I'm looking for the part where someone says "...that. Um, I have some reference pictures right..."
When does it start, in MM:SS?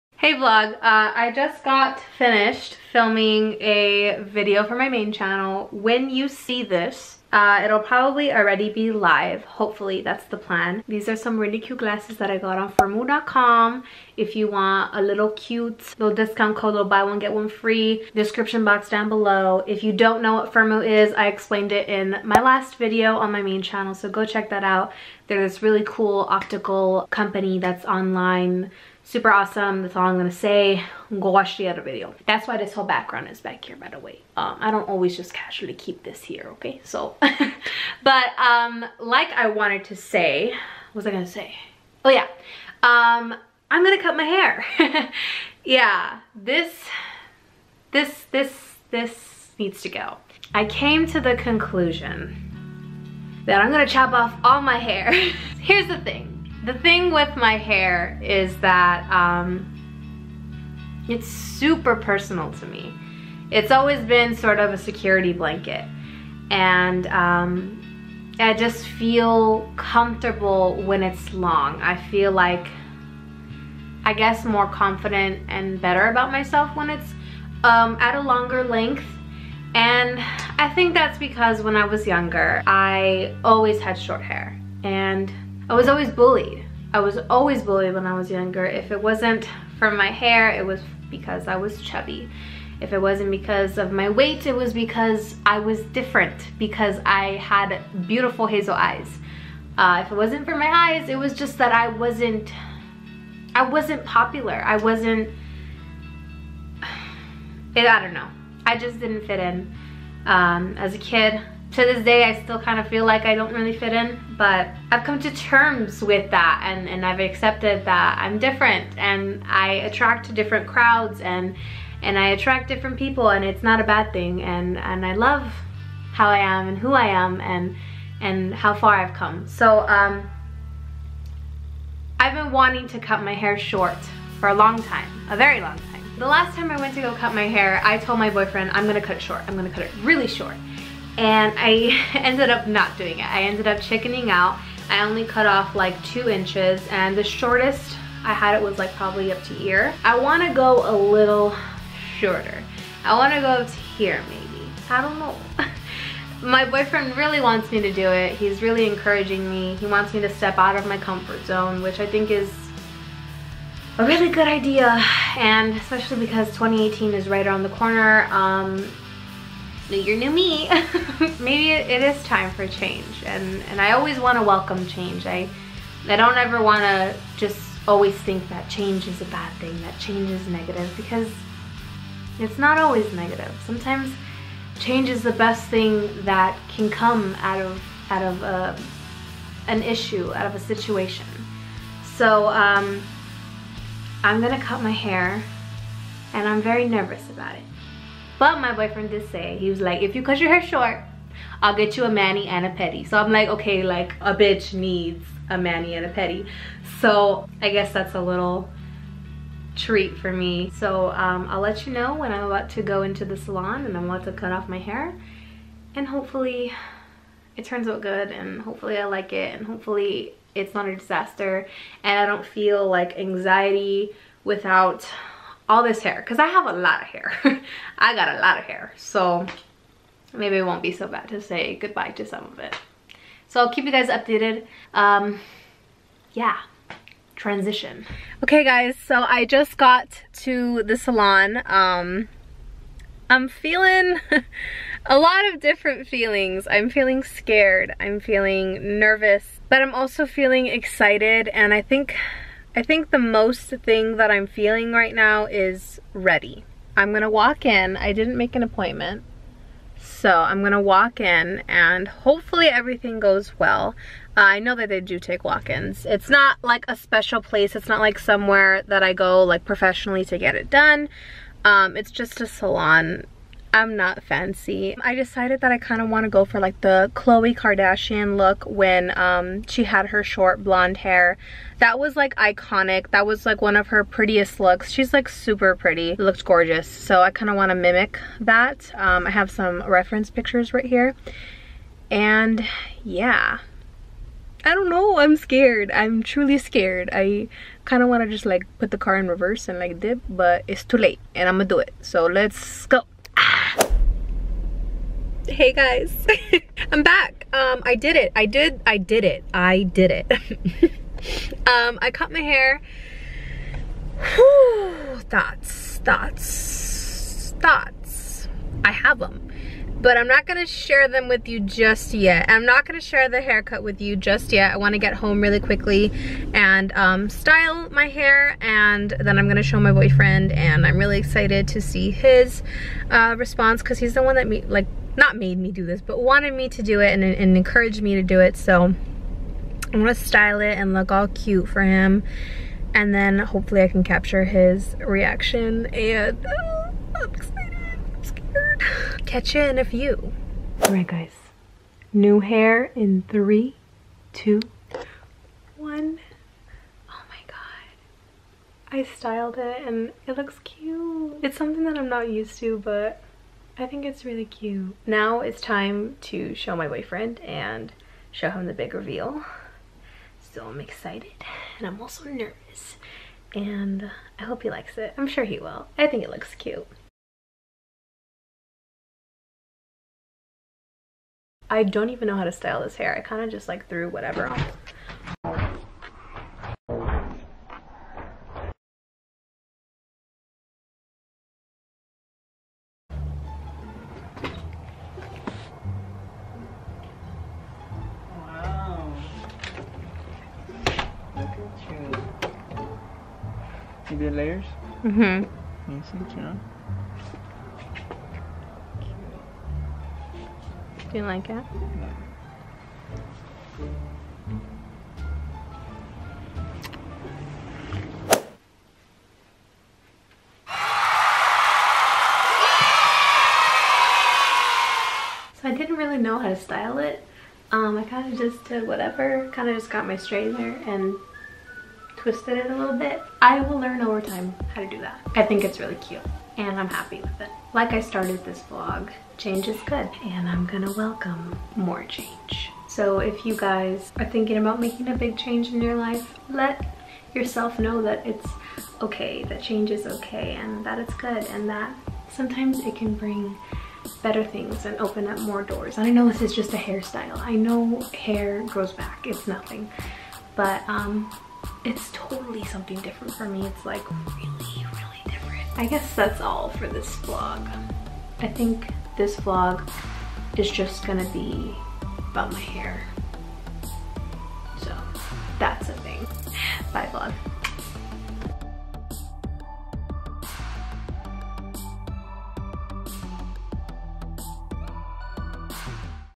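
04:48.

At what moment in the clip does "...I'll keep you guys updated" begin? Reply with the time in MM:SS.
03:53.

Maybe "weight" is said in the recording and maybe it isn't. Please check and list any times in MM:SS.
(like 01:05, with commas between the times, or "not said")
01:34.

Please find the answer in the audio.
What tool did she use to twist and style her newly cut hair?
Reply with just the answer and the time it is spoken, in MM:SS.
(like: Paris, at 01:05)
Straightener, at 07:10.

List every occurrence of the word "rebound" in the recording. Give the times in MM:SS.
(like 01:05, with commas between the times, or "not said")
not said.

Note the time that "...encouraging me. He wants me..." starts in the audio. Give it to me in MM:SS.
02:38.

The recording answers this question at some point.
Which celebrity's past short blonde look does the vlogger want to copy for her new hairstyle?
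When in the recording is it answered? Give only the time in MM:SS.
04:37.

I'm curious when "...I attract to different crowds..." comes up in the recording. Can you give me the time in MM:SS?
01:59.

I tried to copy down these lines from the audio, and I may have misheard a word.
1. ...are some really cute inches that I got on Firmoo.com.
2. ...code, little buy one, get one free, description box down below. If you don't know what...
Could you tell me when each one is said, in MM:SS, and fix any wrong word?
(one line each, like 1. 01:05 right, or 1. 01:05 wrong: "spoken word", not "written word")
1. 00:11 wrong: "glasses", not "inches"
2. 00:16 right.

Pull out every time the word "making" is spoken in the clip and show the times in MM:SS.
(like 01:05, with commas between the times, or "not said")
07:24.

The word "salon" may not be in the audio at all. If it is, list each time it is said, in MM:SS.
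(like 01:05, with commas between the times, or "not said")
03:33, 04:00, 04:32.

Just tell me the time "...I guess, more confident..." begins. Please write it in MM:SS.
01:14.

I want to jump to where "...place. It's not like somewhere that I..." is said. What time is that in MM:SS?
04:27.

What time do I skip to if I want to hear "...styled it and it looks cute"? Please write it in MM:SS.
05:59.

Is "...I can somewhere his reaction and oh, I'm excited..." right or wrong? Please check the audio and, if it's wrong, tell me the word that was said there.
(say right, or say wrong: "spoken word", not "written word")
wrong: "capture", not "somewhere".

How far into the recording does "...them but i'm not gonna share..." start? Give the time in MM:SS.
05:19.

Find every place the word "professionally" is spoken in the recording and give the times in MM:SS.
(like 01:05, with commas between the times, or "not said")
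04:29.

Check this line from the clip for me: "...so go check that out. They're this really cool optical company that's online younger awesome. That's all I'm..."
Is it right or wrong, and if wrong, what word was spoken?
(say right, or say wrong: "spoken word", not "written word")
wrong: "super", not "younger".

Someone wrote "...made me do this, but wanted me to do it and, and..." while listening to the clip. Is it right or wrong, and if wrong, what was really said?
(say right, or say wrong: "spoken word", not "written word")
right.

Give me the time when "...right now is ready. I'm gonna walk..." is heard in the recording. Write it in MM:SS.
04:14.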